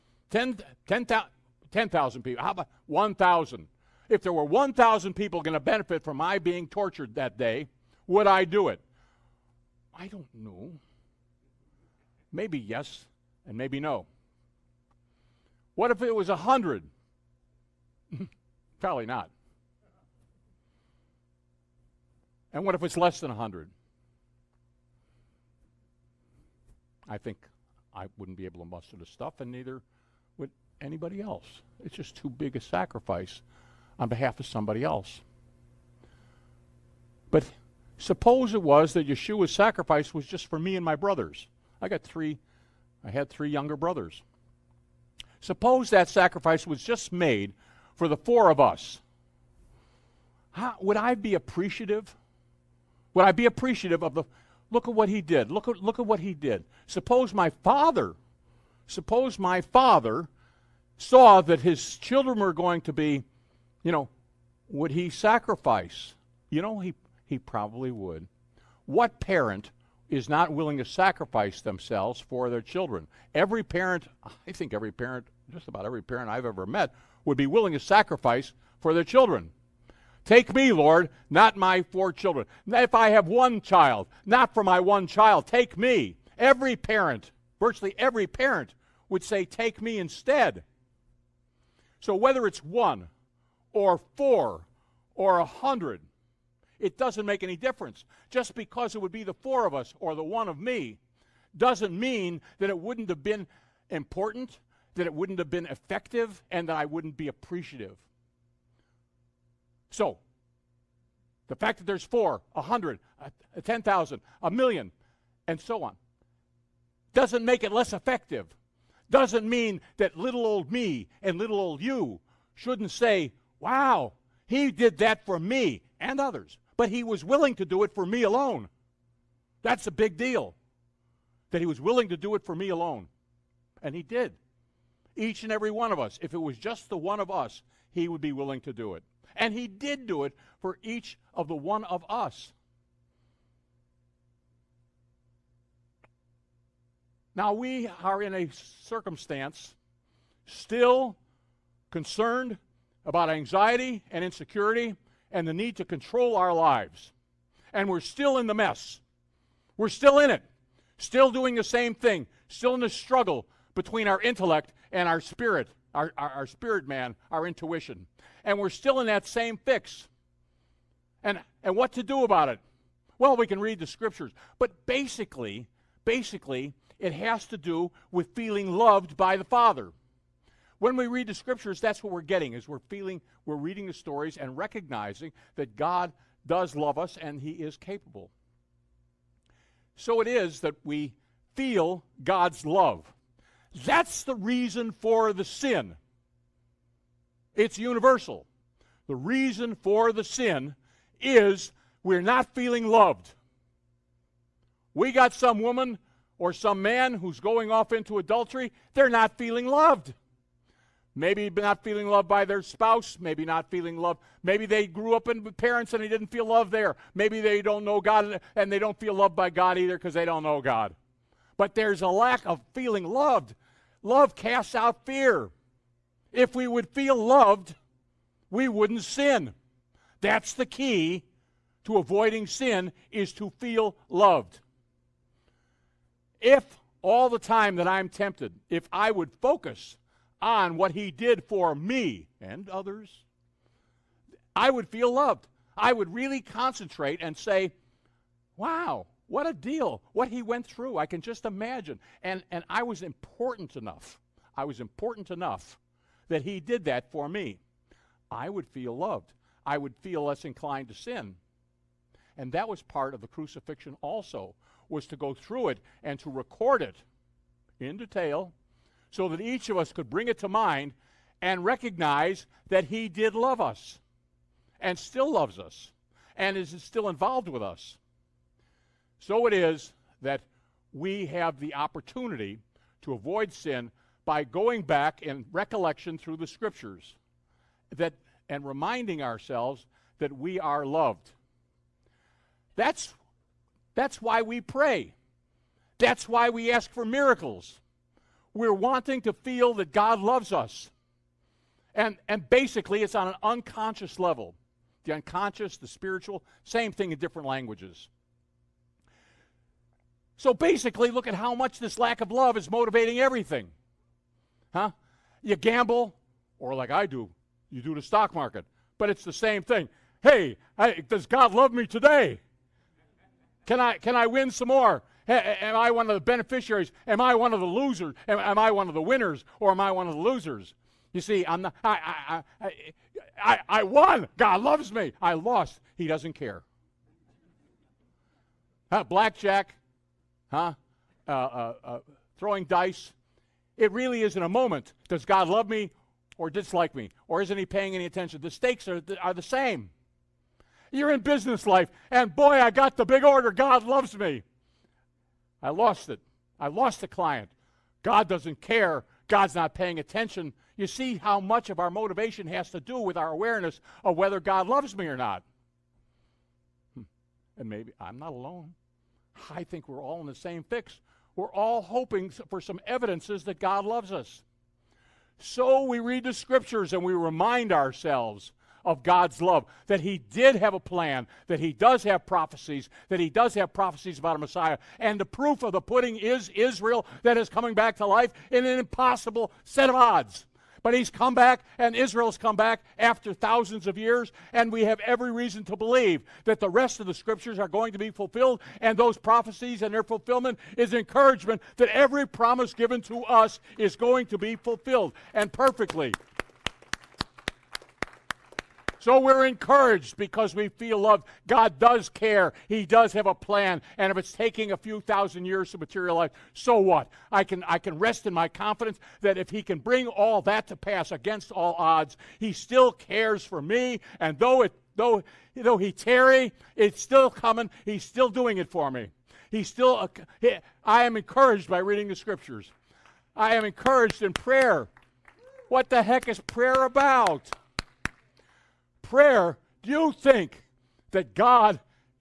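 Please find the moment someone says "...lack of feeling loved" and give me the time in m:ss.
3:42.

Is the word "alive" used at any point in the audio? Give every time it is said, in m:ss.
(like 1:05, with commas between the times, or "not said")
not said.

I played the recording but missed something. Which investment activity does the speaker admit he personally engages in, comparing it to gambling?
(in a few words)
The stock market.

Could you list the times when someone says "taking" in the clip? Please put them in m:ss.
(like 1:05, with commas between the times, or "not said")
6:54.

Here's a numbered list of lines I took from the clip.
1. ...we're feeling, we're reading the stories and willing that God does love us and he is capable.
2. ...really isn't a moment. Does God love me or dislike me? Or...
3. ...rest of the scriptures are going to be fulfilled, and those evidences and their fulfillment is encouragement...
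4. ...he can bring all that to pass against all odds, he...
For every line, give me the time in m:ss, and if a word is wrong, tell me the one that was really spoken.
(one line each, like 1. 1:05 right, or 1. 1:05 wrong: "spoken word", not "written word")
1. 3:02 wrong: "recognizing", not "willing"
2. 5:43 right
3. 6:36 wrong: "prophecies", not "evidences"
4. 6:59 right.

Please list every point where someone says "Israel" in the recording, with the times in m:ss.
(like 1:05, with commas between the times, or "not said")
6:26, 6:31.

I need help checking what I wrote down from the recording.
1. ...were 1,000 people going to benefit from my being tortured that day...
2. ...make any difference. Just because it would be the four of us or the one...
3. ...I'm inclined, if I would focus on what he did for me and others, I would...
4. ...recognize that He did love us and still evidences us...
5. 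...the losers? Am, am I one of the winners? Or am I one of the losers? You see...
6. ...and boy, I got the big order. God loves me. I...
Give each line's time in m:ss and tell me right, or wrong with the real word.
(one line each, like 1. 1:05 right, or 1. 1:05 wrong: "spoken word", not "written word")
1. 0:04 right
2. 1:37 right
3. 3:57 wrong: "tempted", not "inclined"
4. 4:31 wrong: "loves", not "evidences"
5. 5:27 right
6. 5:52 right.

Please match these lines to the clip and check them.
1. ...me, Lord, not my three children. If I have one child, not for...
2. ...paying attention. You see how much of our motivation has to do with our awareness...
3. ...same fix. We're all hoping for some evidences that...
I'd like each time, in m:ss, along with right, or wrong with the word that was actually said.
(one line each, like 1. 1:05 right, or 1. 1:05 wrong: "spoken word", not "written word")
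1. 1:20 wrong: "four", not "three"
2. 5:59 right
3. 6:10 right.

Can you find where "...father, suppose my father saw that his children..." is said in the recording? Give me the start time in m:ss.
0:57.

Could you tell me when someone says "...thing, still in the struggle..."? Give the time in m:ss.
2:41.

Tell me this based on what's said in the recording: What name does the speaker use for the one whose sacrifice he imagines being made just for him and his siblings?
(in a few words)
Yeshua.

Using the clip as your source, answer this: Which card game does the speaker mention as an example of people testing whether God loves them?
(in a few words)
Blackjack.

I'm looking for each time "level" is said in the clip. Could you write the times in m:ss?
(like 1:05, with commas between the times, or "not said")
5:04.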